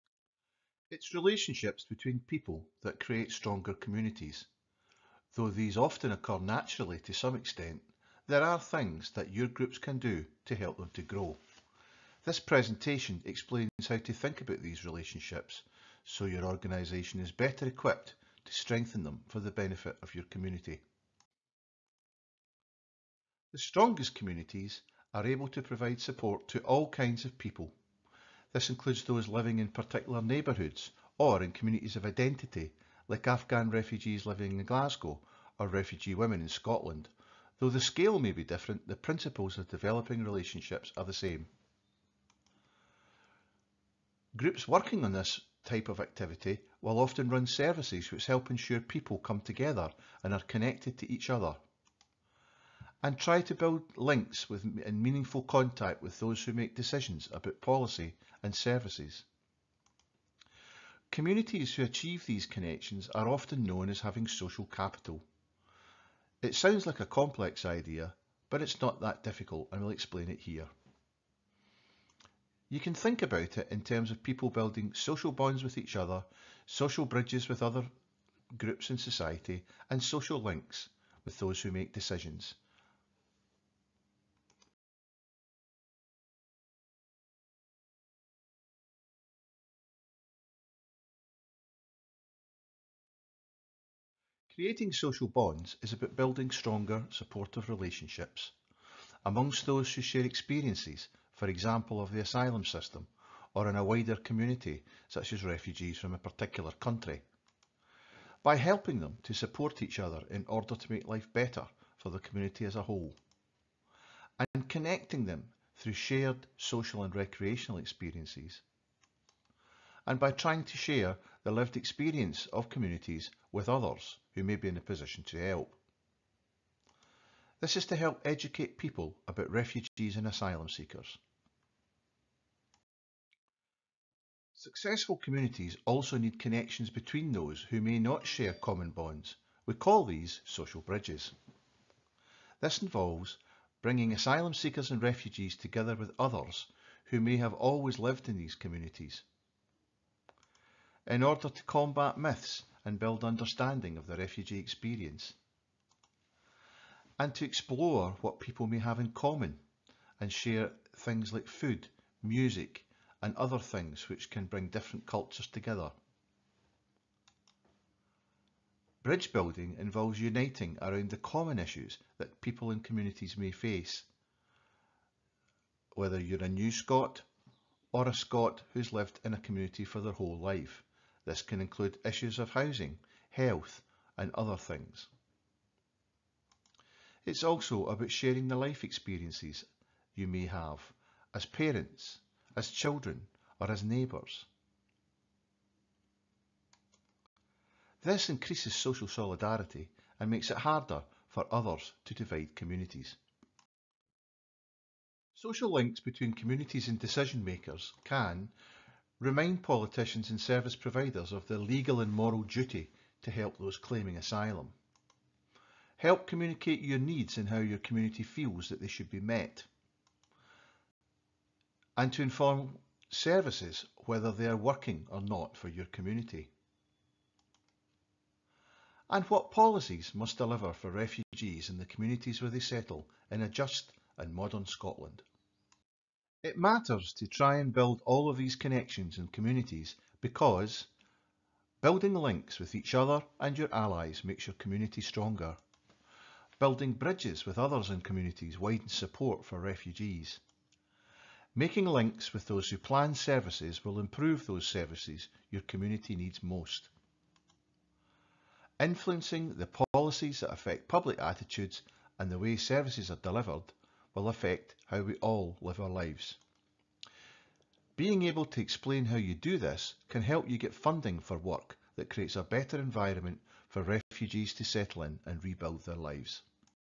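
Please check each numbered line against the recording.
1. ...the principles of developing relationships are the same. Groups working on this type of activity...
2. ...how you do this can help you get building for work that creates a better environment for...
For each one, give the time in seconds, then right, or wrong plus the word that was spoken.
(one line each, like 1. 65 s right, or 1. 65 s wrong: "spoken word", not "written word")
1. 38 s right
2. 269 s wrong: "funding", not "building".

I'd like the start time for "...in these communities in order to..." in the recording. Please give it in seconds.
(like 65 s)
148 s.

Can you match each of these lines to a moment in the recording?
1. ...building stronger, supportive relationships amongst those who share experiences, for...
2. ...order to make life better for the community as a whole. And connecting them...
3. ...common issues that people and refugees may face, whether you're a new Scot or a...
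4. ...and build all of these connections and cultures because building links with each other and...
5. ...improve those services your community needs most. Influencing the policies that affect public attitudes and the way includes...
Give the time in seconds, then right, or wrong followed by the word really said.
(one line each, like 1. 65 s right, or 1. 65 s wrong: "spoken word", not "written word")
1. 96 s right
2. 110 s right
3. 171 s wrong: "communities", not "refugees"
4. 237 s wrong: "communities", not "cultures"
5. 253 s wrong: "services", not "includes".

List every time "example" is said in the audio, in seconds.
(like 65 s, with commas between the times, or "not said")
101 s.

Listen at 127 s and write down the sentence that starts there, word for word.
This is to help educate people about refugees and asylum seekers.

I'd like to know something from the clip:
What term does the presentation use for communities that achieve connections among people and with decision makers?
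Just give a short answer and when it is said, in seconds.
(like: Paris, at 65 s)
Social capital, at 64 s.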